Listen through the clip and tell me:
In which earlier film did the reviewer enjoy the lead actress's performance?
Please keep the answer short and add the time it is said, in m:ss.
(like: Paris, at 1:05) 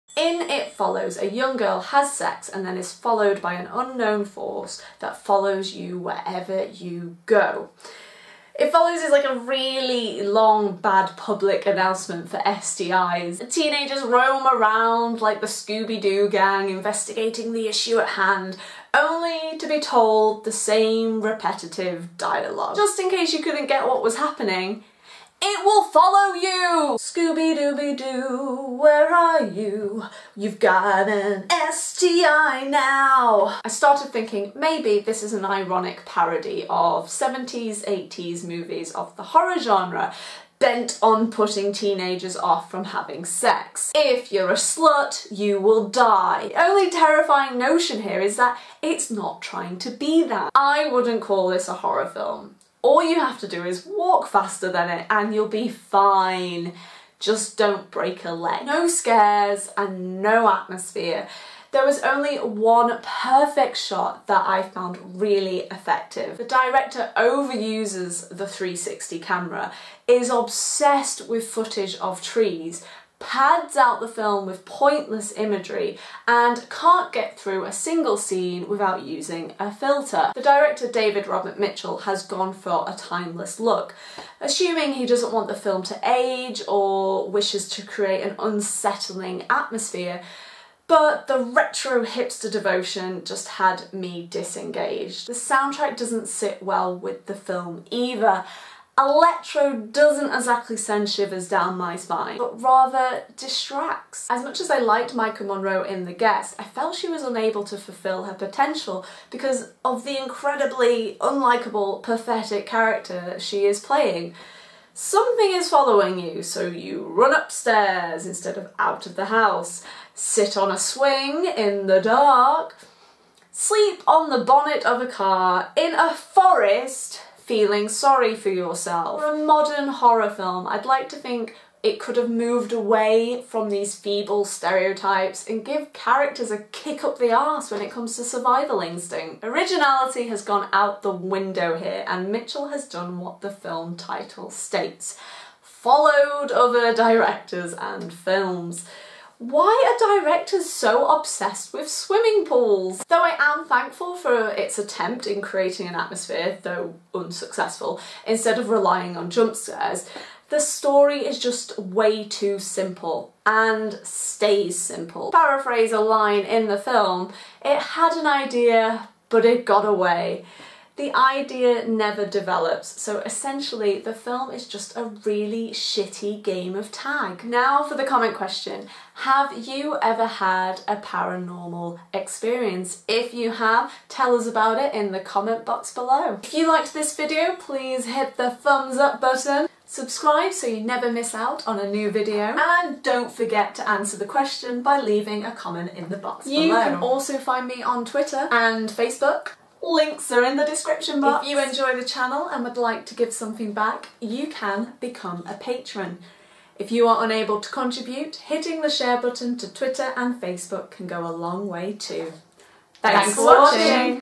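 The Guest, at 1:46.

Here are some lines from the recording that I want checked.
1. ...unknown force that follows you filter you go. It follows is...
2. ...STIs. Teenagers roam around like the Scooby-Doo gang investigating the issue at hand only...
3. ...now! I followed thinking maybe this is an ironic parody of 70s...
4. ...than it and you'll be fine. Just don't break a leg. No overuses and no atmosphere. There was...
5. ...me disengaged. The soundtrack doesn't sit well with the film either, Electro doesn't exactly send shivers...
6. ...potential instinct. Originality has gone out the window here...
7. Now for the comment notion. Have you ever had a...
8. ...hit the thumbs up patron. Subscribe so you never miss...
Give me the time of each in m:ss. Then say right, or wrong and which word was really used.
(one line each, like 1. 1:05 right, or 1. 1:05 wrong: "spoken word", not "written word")
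1. 0:03 wrong: "wherever", not "filter"
2. 0:12 right
3. 0:32 wrong: "started", not "followed"
4. 0:54 wrong: "scares", not "overuses"
5. 1:33 right
6. 2:18 wrong: "survival", not "potential"
7. 2:57 wrong: "question", not "notion"
8. 3:08 wrong: "button", not "patron".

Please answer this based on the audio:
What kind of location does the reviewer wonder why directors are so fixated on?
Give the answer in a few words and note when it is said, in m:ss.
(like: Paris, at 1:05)
swimming pools, at 2:31.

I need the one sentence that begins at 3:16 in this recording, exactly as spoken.
You can also find me on Twitter and Facebook Links are in the description box.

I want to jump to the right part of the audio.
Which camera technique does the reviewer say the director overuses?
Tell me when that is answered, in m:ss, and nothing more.
1:08.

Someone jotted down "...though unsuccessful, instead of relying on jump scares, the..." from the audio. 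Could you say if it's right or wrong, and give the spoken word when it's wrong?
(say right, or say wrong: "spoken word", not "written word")
right.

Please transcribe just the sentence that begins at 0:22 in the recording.
Just in case you couldn't get what was happening, it will follow you!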